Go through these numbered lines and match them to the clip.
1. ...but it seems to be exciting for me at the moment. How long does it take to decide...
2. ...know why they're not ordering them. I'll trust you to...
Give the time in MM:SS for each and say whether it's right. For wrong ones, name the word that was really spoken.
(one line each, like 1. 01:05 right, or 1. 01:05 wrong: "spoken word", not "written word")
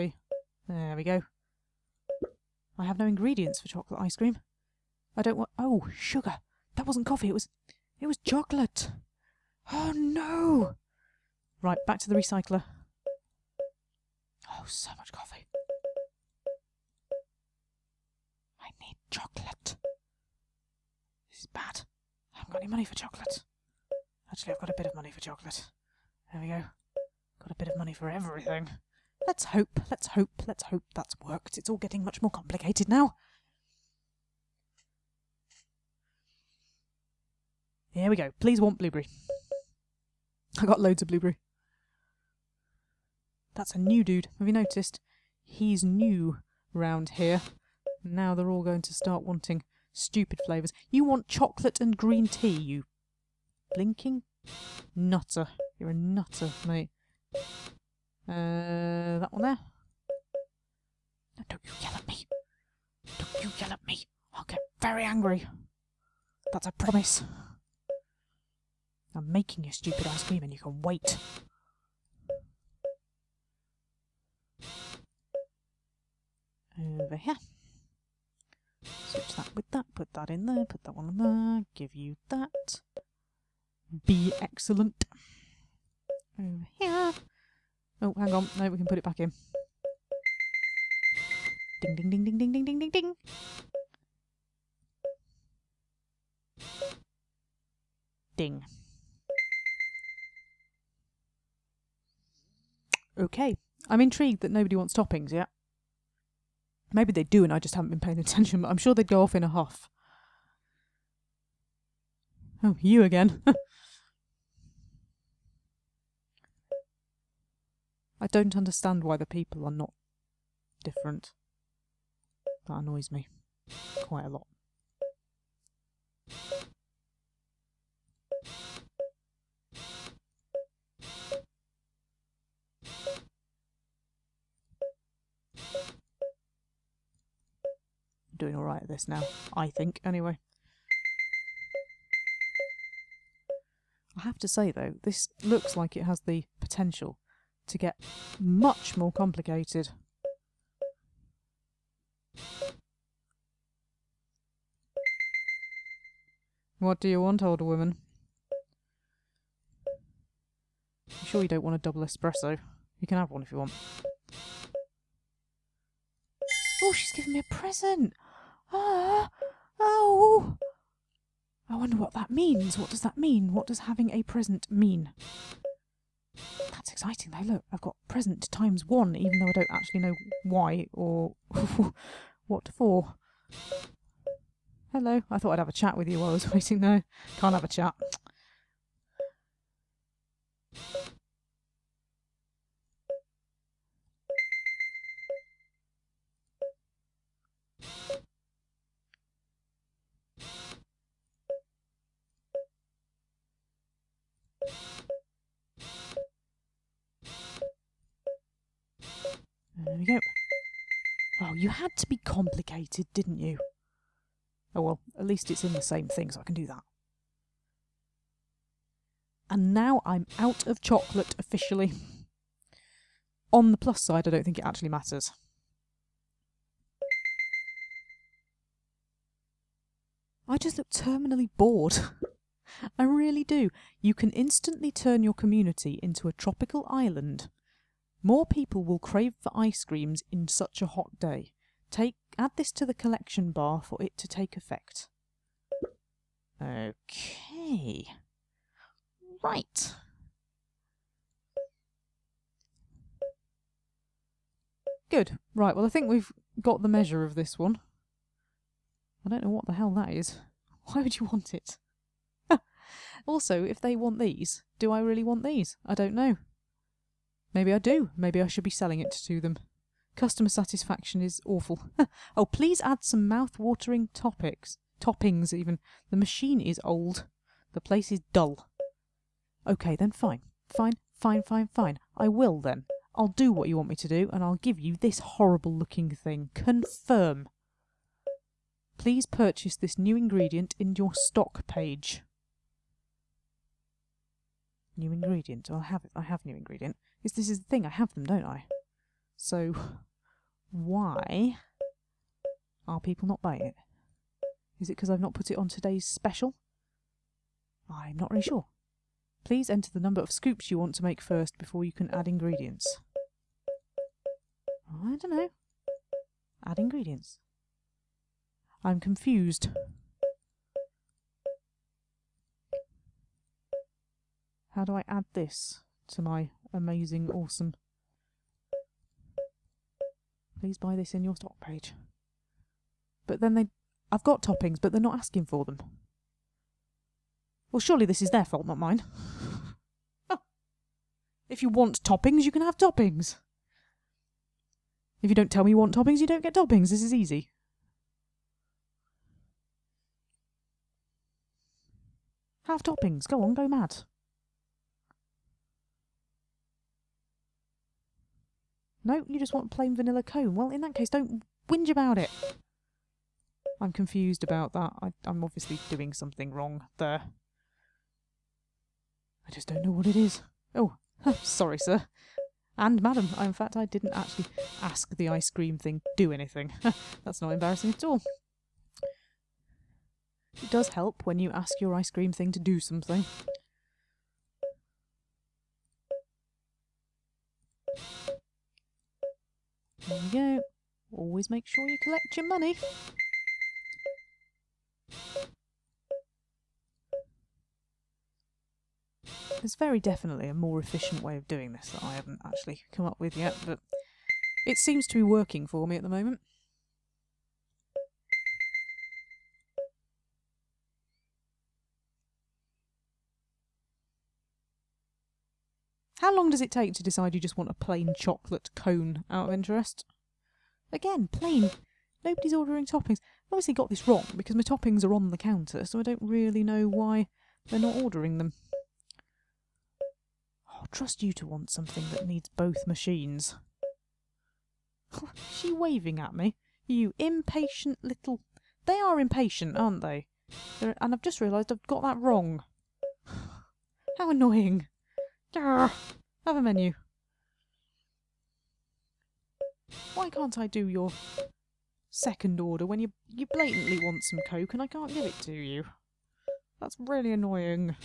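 1. 06:43 wrong: "working", not "exciting"
2. 07:06 right.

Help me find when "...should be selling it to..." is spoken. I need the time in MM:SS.
04:28.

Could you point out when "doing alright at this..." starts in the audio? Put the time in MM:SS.
02:18.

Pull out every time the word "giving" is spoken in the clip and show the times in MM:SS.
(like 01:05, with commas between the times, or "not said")
02:47.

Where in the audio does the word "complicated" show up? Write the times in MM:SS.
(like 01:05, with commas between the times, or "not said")
00:32, 02:29, 03:32.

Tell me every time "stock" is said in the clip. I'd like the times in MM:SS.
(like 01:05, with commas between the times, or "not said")
04:51, 05:31.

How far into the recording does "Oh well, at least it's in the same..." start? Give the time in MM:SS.
03:34.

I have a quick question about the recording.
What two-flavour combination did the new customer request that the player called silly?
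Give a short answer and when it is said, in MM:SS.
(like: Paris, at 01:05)
chocolate and green tea, at 00:51.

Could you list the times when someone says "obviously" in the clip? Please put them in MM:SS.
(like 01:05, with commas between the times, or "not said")
06:05, 07:03.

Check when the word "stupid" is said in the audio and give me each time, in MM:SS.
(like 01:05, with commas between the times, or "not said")
00:49, 01:09.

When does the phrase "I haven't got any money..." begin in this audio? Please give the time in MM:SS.
00:22.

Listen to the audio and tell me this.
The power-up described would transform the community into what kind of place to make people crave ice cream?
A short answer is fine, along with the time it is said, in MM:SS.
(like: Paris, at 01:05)
tropical island, at 03:56.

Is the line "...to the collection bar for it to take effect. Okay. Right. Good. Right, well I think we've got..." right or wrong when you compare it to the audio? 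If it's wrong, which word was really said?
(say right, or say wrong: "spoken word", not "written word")
right.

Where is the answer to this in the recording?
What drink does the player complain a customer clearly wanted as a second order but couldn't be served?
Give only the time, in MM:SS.
07:34.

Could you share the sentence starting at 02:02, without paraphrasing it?
That annoys me quite a lot.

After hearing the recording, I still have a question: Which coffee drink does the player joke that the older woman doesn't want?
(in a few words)
double espresso.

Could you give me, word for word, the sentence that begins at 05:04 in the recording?
Is it because I've not put it on today's special?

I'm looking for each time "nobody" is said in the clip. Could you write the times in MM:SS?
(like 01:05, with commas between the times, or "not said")
01:44, 07:02.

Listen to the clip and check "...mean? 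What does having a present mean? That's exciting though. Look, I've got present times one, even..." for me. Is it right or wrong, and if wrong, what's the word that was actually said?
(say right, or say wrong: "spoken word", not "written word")
right.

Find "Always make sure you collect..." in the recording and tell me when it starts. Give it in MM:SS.
06:31.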